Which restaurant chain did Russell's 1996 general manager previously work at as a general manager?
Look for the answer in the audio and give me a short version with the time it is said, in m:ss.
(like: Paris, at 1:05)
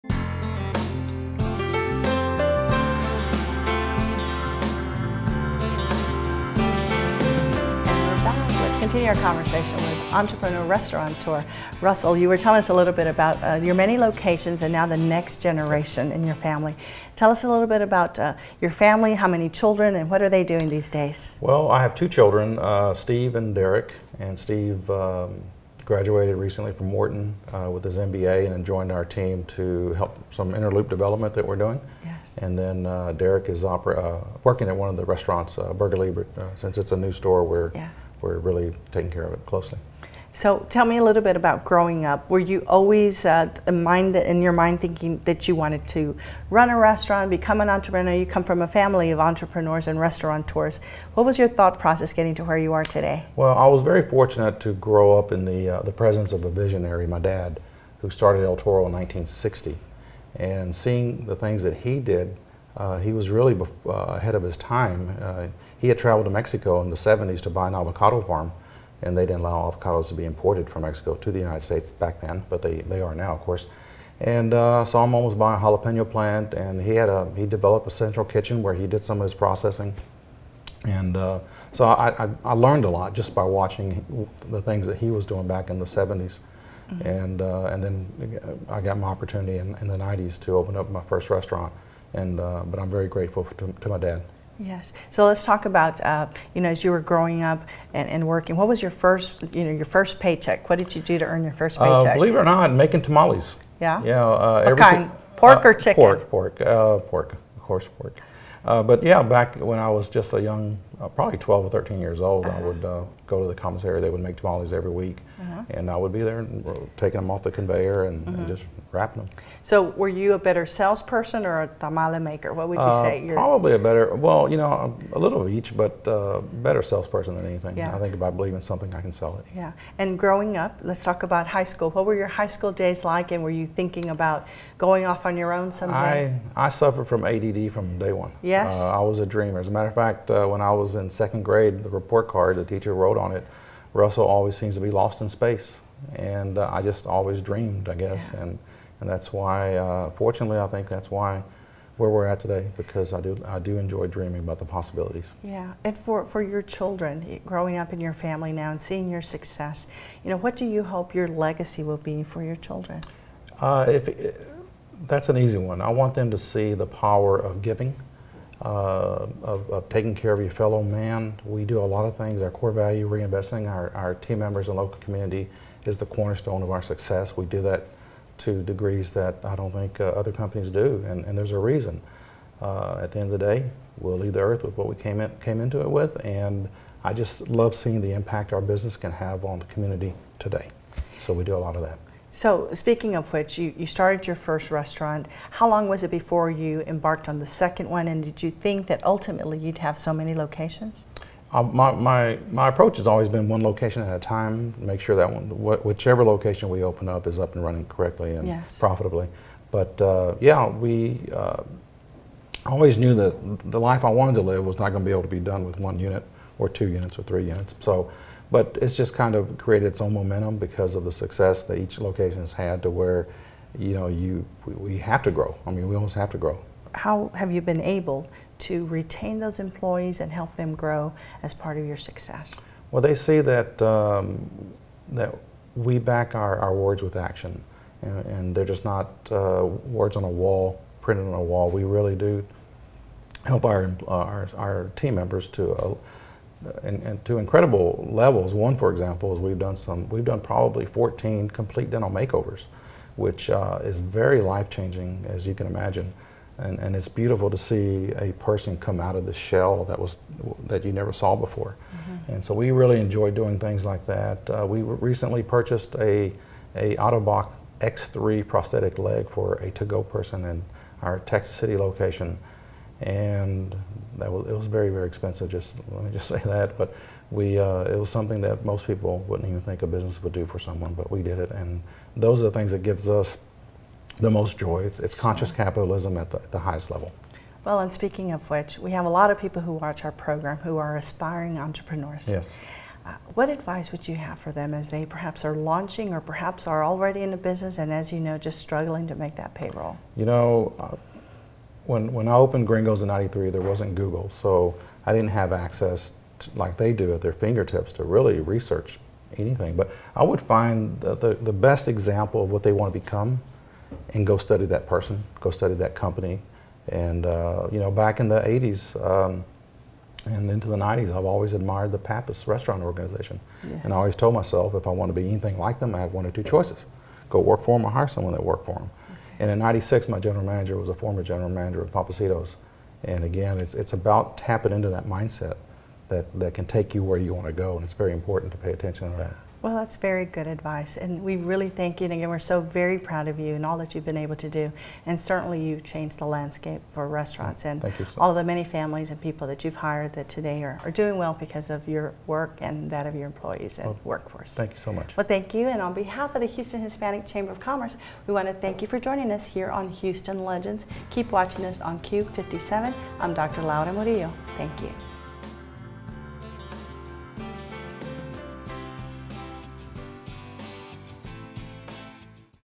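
Pappasitos, at 5:31.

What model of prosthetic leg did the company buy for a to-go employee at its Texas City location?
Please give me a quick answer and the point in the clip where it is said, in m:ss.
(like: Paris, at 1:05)
Ottobock X3, at 4:26.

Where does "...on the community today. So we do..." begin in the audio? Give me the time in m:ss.
3:09.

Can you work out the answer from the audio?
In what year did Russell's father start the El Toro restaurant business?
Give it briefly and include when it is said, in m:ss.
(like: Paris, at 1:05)
1960, at 0:58.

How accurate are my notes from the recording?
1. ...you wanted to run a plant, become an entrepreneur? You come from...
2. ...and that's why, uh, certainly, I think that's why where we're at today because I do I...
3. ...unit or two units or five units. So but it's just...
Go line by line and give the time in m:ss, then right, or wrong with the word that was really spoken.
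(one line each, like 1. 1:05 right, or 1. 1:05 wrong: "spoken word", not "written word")
1. 0:45 wrong: "restaurant", not "plant"
2. 2:28 wrong: "fortunately", not "certainly"
3. 3:35 wrong: "three", not "five".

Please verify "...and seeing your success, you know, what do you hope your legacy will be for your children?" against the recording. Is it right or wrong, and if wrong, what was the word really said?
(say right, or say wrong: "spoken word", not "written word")
right.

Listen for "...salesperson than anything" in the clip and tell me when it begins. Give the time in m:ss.
2:06.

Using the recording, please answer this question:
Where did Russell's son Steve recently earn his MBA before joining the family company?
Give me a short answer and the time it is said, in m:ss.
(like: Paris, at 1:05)
Wharton, at 0:26.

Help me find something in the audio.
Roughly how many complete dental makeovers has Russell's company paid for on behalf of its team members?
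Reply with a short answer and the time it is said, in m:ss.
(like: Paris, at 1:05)
14, at 4:10.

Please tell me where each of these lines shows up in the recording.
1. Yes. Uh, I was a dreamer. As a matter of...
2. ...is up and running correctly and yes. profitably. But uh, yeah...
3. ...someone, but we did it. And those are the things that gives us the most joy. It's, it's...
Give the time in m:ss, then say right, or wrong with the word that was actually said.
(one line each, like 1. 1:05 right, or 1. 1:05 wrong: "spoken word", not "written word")
1. 2:18 right
2. 3:27 right
3. 4:40 right.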